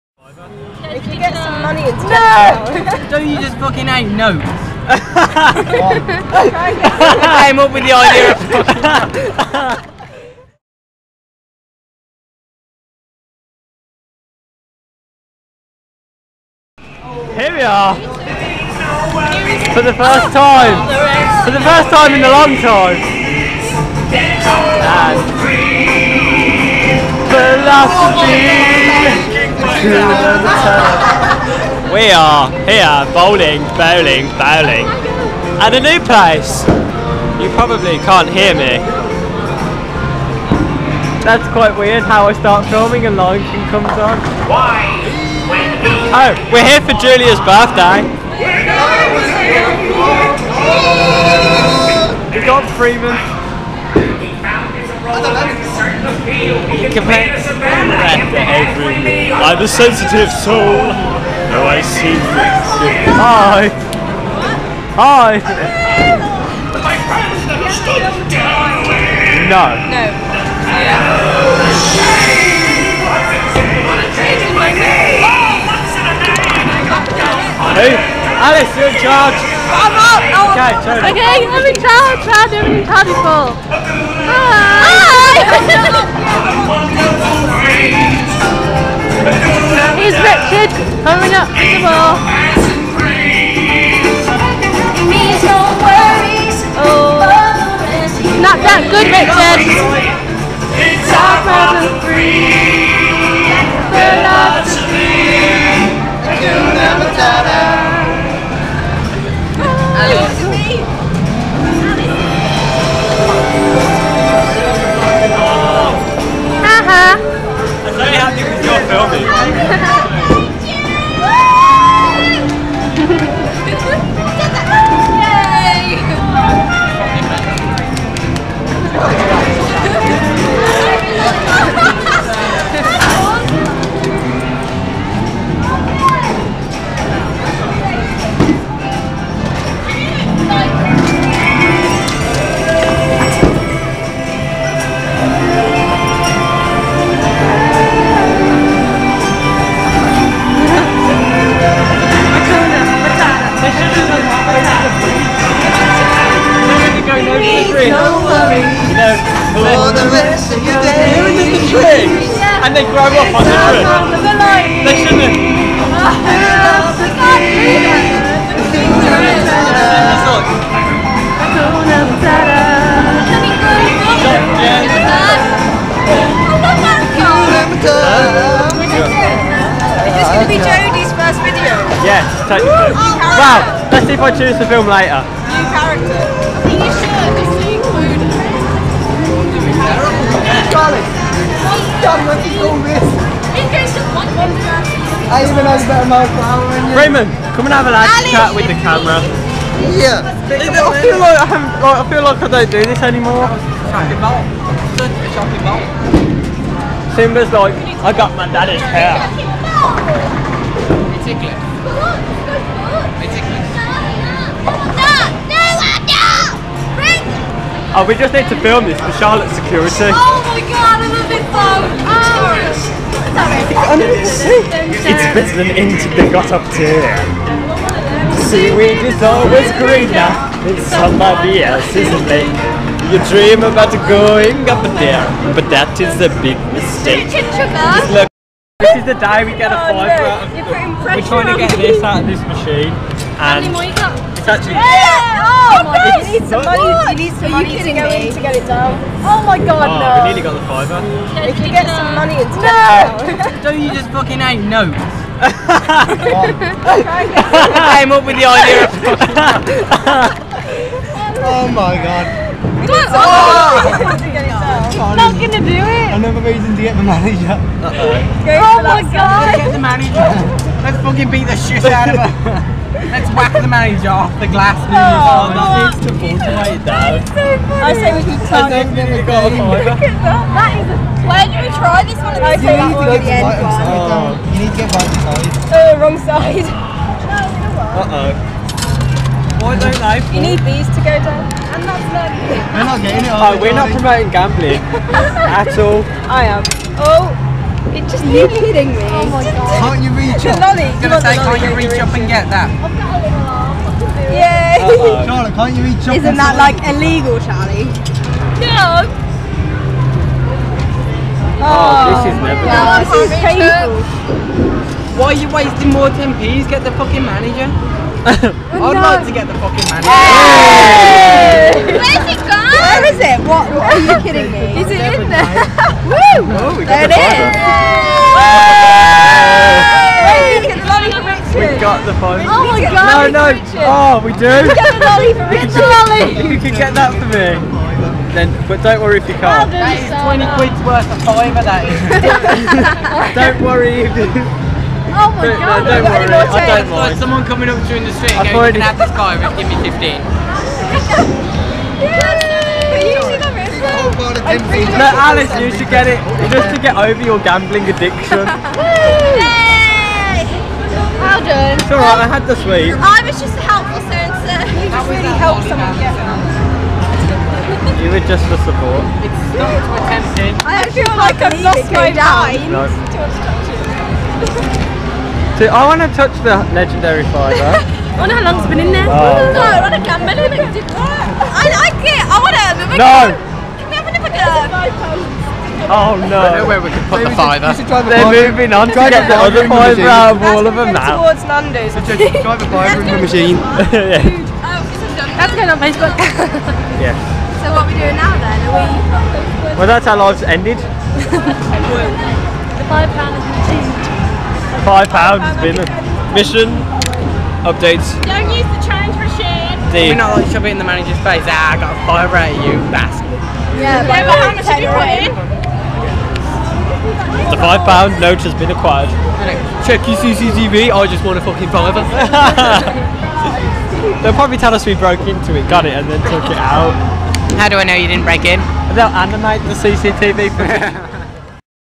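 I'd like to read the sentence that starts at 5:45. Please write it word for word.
Oh my but, god, no, don't worry, I don't mind.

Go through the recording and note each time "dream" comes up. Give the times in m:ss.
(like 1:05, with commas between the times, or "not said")
3:53.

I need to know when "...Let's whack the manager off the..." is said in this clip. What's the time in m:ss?
4:33.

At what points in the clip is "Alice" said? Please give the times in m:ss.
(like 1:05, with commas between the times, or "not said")
1:17, 5:55.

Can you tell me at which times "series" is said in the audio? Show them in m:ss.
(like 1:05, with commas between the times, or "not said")
not said.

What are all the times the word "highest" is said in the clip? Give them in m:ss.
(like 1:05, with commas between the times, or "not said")
not said.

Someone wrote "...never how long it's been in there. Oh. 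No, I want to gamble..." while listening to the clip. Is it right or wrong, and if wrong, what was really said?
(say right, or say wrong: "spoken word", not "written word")
wrong: "wonder", not "never".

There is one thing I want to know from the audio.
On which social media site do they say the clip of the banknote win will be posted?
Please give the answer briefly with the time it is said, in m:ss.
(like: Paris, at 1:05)
Facebook, at 6:35.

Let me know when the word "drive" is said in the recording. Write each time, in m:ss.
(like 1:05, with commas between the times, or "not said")
6:32.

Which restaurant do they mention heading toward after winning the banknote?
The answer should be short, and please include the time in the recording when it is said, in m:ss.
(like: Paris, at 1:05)
Nando's, at 6:31.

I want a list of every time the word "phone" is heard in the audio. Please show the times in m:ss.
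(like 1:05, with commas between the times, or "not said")
3:41, 5:32.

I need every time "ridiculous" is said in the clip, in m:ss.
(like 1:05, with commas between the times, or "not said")
not said.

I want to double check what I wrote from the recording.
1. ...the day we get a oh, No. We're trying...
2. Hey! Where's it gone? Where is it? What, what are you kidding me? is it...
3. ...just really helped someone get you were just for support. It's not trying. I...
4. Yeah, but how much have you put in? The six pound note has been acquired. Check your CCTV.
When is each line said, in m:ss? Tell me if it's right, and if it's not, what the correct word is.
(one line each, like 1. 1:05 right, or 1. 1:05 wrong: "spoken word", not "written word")
1. 3:59 right
2. 5:20 right
3. 6:04 wrong: "attempting", not "trying"
4. 6:53 wrong: "five", not "six".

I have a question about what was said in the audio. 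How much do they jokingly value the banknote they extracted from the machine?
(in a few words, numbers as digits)
20 quid.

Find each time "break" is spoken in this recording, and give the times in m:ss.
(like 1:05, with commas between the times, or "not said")
7:08.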